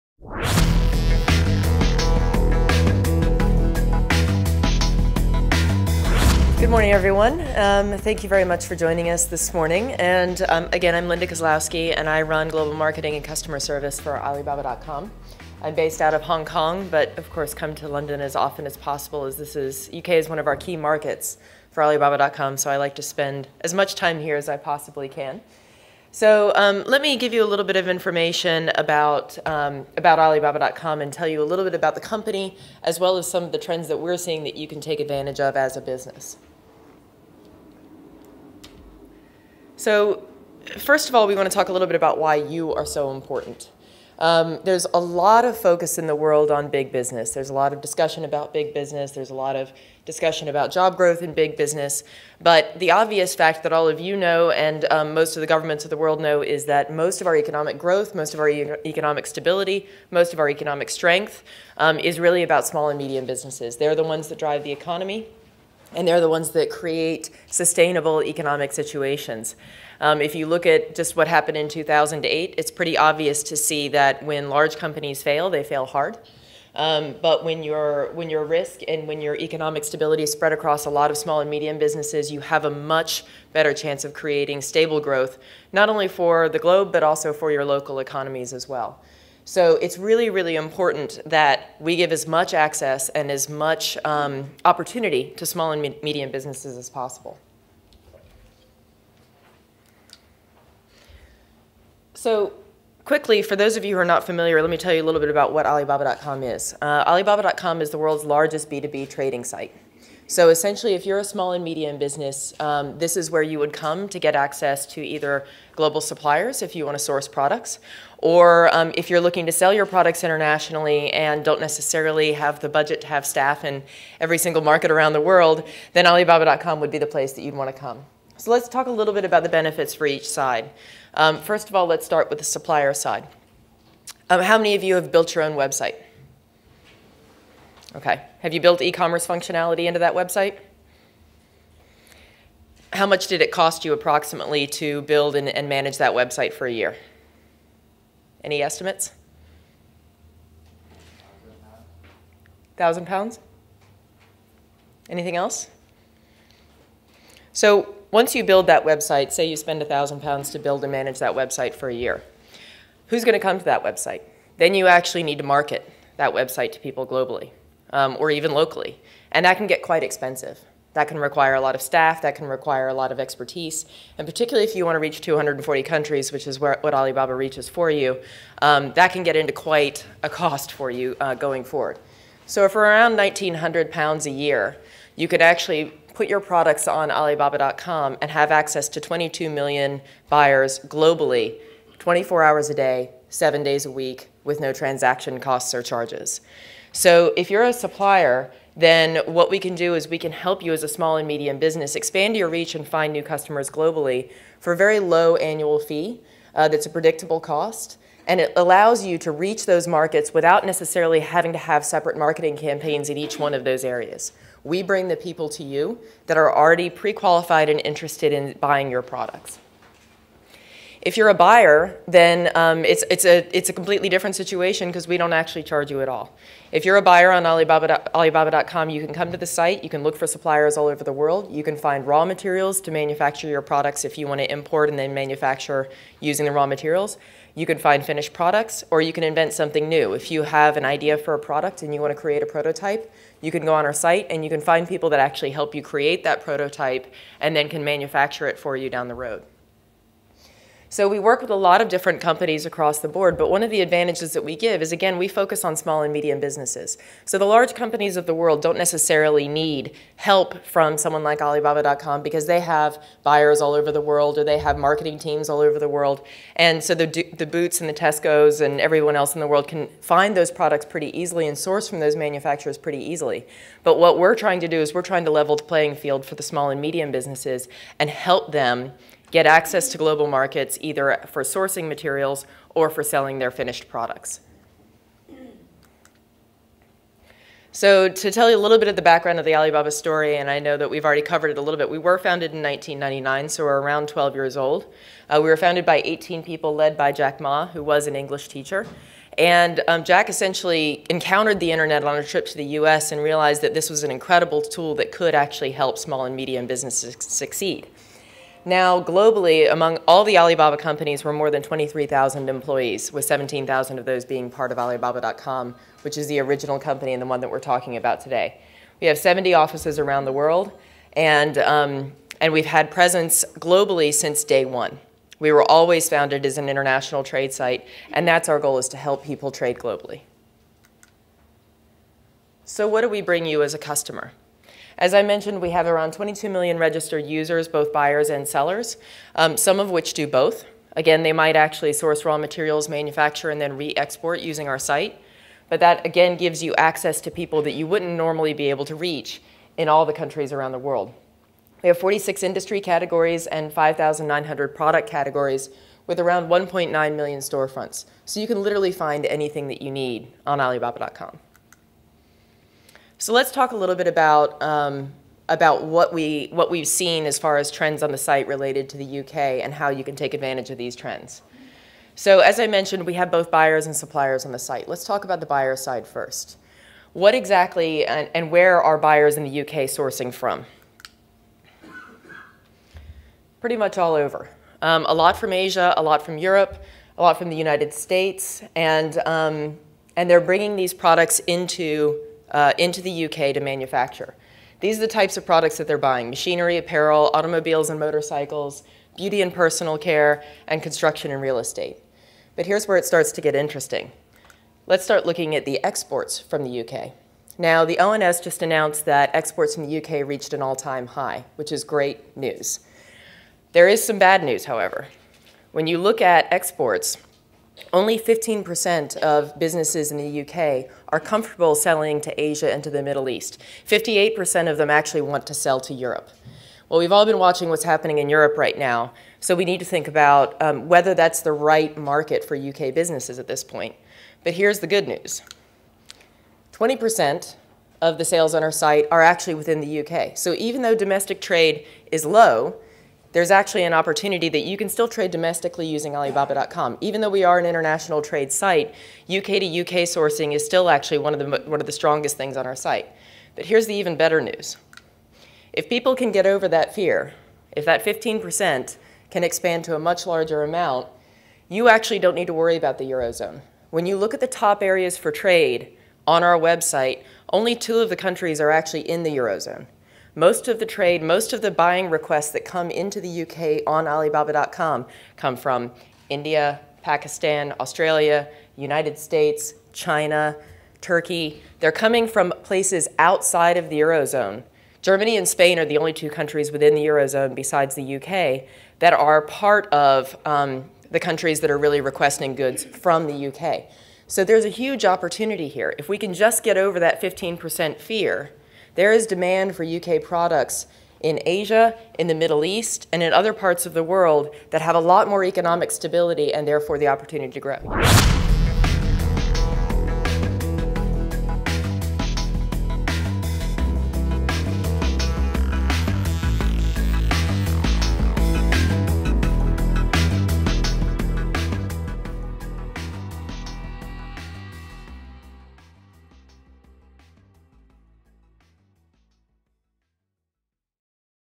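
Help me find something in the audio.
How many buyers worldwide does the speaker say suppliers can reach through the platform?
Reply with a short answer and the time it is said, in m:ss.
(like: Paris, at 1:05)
22 million, at 3:08.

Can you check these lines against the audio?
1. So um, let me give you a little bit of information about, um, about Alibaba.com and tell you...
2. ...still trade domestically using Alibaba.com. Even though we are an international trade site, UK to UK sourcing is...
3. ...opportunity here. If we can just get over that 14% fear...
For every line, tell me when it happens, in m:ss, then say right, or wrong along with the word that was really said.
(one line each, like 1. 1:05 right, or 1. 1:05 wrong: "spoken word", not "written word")
1. 0:26 right
2. 7:24 right
3. 8:15 wrong: "15", not "14".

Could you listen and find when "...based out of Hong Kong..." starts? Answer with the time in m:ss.
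0:15.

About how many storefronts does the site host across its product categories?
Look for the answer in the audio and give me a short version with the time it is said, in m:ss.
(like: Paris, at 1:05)
1.9 million, at 5:56.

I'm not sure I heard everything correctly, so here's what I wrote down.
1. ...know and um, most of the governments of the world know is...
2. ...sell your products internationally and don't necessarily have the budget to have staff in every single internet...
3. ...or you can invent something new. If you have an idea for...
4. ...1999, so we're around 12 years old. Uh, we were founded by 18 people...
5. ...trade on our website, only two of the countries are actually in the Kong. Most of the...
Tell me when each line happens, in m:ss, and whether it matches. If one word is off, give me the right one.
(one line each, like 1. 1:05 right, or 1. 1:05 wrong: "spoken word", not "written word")
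1. 0:54 right
2. 1:59 wrong: "market", not "internet"
3. 3:58 right
4. 4:52 right
5. 7:45 wrong: "Eurozone", not "Kong".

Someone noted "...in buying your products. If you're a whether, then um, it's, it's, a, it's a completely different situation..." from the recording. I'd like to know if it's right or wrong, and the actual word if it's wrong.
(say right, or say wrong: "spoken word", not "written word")
wrong: "buyer", not "whether".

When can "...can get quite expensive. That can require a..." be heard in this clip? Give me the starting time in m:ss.
2:49.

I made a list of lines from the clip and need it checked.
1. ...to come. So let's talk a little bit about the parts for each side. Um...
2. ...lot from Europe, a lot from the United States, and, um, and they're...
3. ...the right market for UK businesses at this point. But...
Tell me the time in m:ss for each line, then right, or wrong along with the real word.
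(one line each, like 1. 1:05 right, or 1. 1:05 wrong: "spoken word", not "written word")
1. 2:07 wrong: "benefits", not "parts"
2. 6:26 right
3. 7:11 right.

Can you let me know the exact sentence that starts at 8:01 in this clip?
They're coming from places outside of the Eurozone.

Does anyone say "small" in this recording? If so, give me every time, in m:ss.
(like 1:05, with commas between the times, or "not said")
1:02, 1:21, 1:35, 1:51, 3:20, 4:15, 4:36, 5:05.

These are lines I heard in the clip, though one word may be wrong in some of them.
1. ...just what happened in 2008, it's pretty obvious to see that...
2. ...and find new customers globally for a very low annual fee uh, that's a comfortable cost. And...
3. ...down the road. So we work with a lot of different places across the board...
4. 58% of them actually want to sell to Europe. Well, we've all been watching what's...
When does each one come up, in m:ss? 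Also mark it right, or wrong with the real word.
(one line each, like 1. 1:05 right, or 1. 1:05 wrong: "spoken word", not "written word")
1. 1:10 right
2. 3:22 wrong: "predictable", not "comfortable"
3. 4:08 wrong: "companies", not "places"
4. 7:03 right.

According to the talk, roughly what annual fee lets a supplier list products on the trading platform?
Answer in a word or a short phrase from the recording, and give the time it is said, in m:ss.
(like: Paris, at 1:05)
1,900 pounds, at 3:03.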